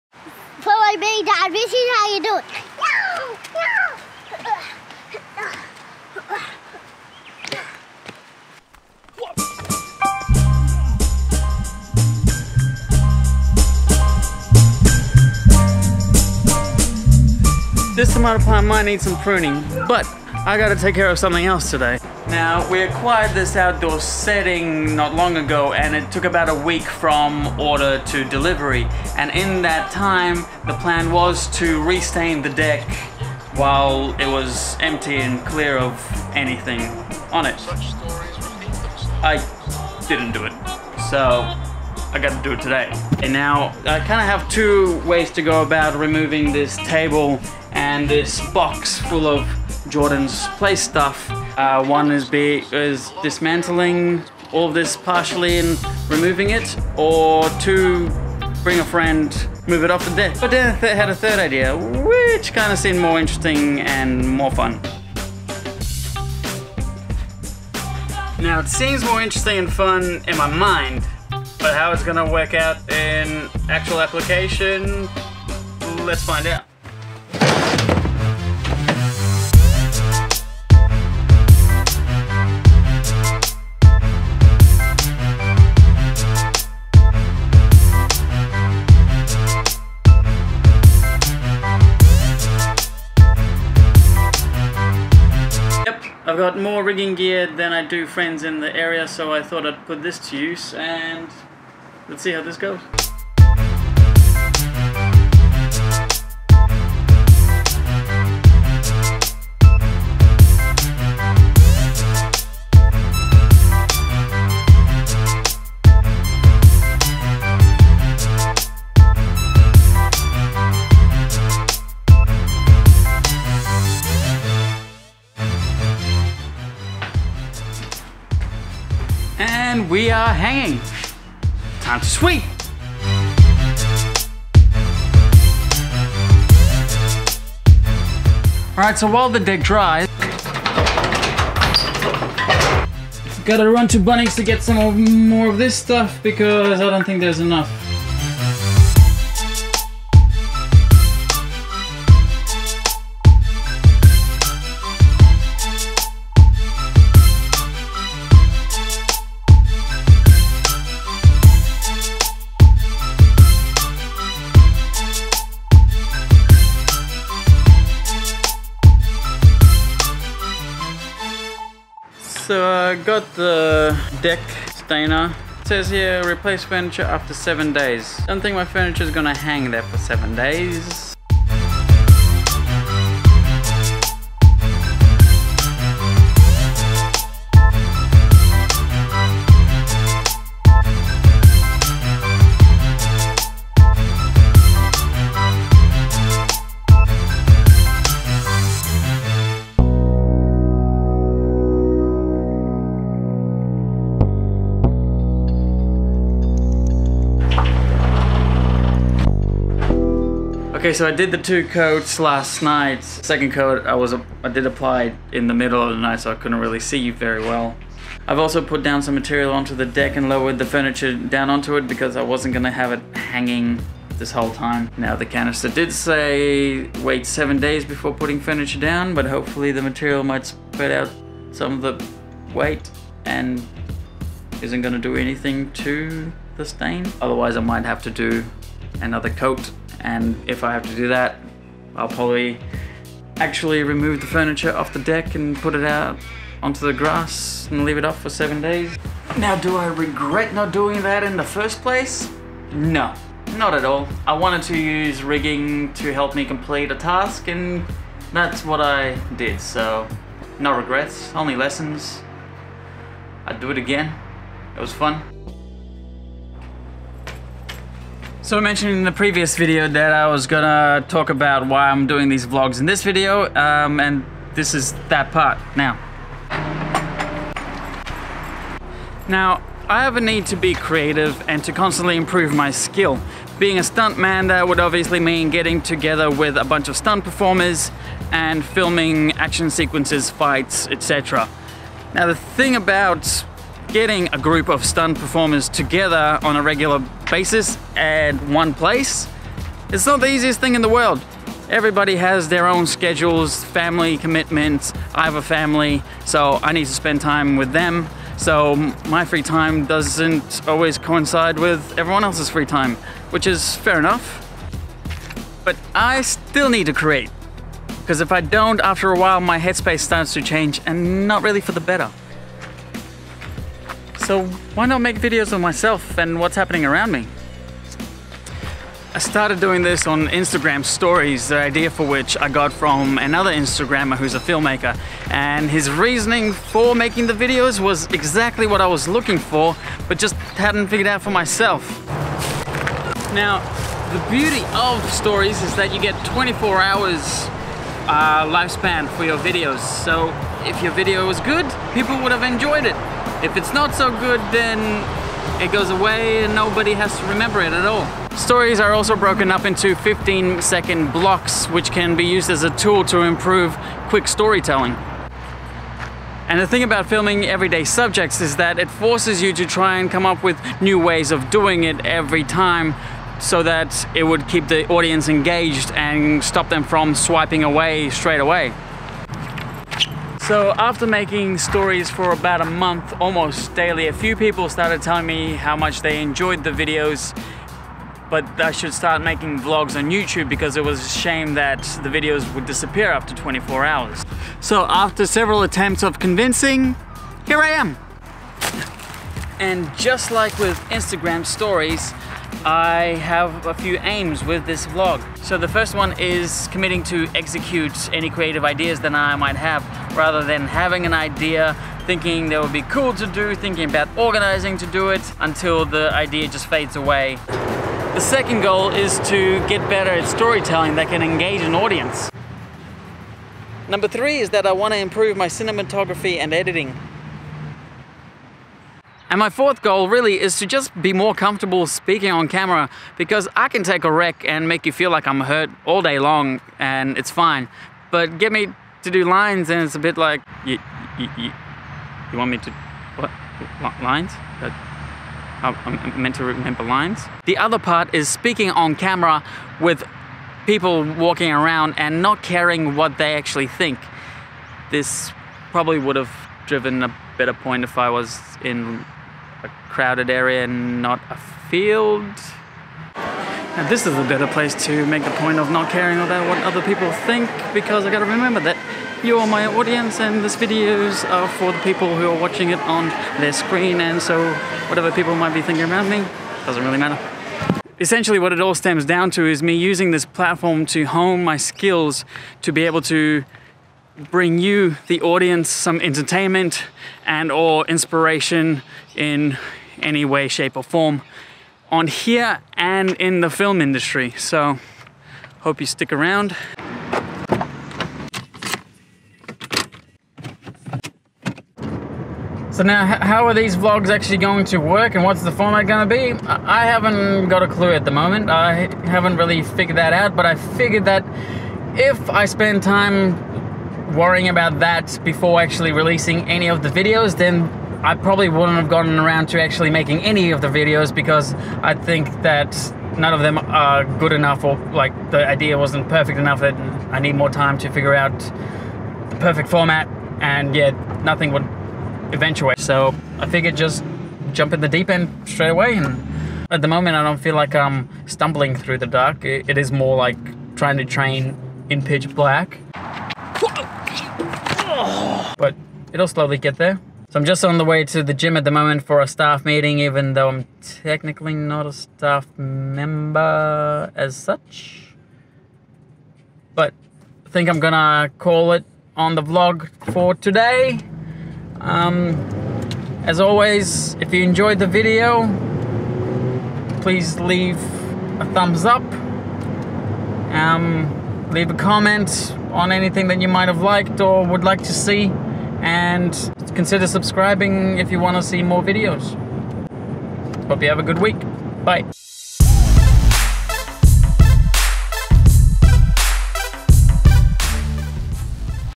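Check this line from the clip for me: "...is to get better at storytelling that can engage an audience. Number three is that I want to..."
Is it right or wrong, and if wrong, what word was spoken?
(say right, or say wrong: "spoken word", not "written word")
right.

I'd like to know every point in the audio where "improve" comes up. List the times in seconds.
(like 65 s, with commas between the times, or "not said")
282 s, 363 s, 424 s.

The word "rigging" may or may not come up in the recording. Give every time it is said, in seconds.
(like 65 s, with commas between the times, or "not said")
96 s, 255 s.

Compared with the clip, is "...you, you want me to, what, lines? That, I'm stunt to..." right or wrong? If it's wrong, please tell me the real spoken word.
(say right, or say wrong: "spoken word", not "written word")
wrong: "meant", not "stunt".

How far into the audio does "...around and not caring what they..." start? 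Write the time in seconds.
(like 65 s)
451 s.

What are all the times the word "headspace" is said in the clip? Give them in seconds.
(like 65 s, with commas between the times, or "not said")
319 s.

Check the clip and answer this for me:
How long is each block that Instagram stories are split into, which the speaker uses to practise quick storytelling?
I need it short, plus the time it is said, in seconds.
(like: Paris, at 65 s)
15 seconds, at 359 s.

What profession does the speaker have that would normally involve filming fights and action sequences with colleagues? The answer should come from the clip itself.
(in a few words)
stuntman.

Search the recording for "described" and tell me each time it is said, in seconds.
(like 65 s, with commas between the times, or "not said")
not said.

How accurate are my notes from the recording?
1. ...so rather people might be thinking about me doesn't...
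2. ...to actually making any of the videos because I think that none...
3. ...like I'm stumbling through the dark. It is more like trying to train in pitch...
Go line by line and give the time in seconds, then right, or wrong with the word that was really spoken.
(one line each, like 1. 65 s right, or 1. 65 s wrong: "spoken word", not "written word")
1. 474 s wrong: "whatever", not "rather"
2. 519 s right
3. 537 s right.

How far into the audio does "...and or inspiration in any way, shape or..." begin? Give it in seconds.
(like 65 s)
487 s.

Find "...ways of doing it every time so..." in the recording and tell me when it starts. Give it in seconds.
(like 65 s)
370 s.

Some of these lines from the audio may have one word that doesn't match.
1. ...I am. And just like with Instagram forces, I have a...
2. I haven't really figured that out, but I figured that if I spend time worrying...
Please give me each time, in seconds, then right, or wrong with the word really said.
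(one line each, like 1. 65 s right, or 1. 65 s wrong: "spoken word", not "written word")
1. 397 s wrong: "stories", not "forces"
2. 508 s right.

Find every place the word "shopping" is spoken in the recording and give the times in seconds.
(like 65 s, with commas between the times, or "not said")
not said.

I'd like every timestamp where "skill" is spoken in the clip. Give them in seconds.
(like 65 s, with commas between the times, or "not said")
282 s, 481 s.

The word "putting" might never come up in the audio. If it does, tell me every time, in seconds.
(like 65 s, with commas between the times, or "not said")
228 s.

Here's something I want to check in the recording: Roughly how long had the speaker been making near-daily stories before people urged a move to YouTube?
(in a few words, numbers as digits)
about a month.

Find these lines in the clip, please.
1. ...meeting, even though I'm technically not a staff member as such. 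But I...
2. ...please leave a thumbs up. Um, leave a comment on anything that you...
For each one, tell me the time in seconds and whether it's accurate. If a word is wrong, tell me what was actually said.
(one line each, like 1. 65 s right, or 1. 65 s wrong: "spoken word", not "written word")
1. 549 s right
2. 567 s right.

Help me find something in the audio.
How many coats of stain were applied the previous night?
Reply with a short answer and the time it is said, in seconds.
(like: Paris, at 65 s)
2, at 211 s.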